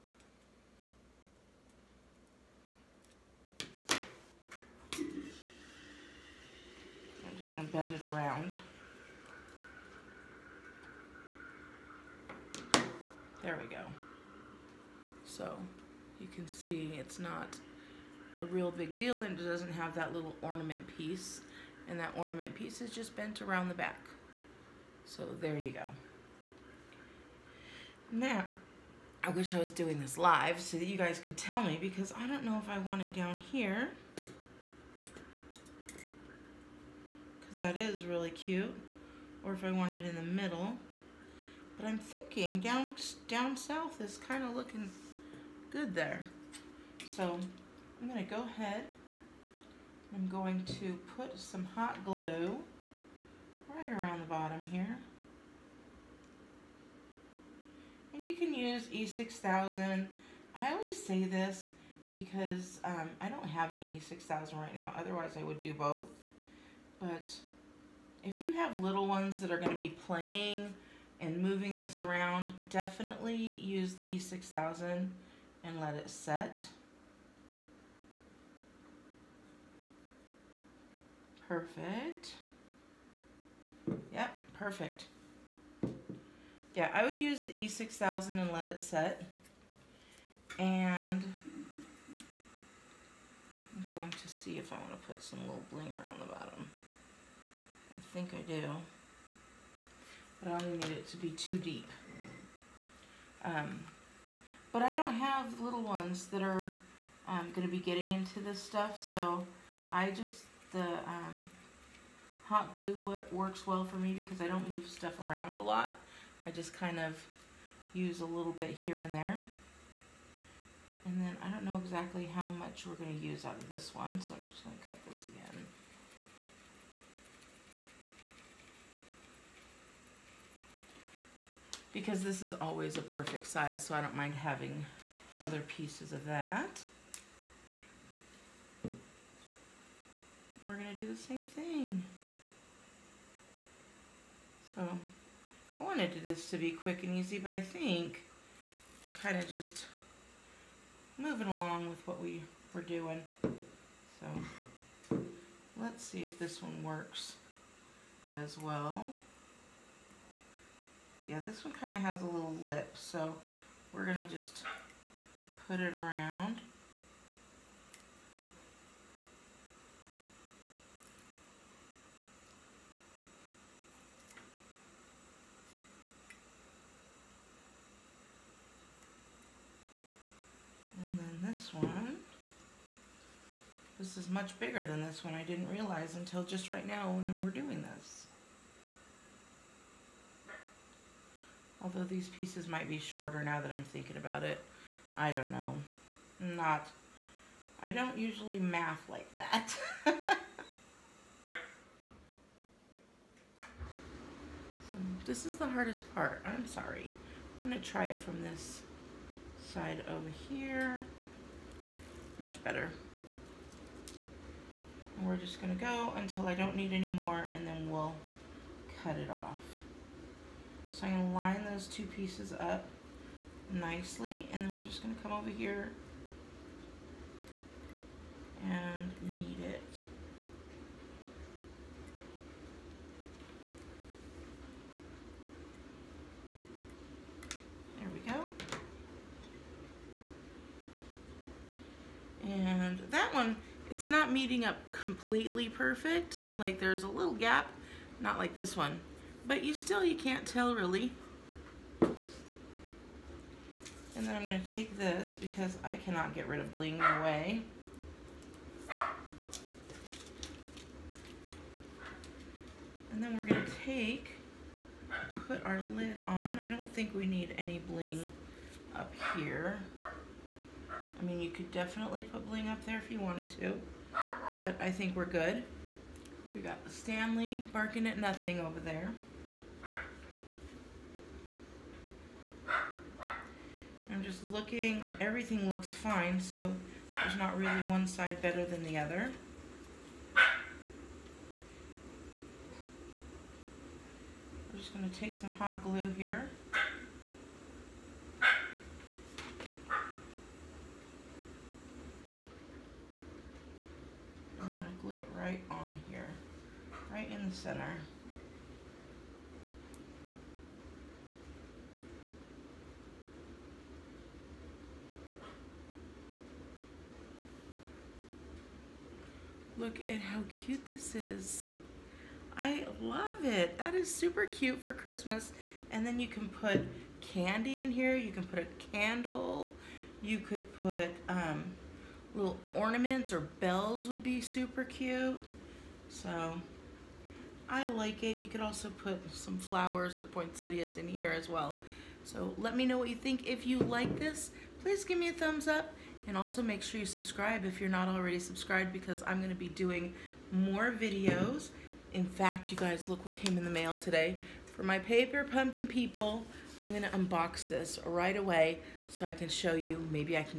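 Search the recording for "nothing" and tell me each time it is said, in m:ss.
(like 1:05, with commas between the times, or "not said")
4:38.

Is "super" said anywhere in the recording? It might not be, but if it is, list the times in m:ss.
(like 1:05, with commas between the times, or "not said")
5:24, 5:34.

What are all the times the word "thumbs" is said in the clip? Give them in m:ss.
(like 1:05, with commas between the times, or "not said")
5:45.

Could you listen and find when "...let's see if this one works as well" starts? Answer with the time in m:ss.
2:35.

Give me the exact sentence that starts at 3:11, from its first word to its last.
Although these pieces might be shorter now that I'm thinking about it.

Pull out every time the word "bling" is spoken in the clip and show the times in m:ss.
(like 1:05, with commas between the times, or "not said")
1:35, 4:16, 4:27, 4:32.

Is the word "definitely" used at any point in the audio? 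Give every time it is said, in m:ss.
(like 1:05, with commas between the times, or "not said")
1:12, 4:31.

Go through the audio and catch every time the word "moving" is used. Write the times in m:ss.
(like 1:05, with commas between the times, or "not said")
1:11, 2:31.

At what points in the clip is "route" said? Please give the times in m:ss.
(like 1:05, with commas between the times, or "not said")
not said.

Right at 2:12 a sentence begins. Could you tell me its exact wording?
because this is always a perfect size, so I don't mind having other pieces of that.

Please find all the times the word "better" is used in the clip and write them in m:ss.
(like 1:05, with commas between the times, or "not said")
3:32, 4:48.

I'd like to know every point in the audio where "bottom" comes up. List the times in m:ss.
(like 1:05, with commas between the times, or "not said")
0:54, 1:36.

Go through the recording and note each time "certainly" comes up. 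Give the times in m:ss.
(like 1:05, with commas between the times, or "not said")
not said.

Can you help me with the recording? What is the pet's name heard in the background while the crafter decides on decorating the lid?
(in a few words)
Stanley.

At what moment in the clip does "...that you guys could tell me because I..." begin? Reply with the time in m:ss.
0:30.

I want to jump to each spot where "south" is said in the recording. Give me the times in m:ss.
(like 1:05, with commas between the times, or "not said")
0:43.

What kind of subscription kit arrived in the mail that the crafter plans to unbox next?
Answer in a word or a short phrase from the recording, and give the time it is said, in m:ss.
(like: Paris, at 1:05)
Paper Pumpkin, at 5:54.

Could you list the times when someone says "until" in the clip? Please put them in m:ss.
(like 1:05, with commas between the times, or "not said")
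3:06, 3:36.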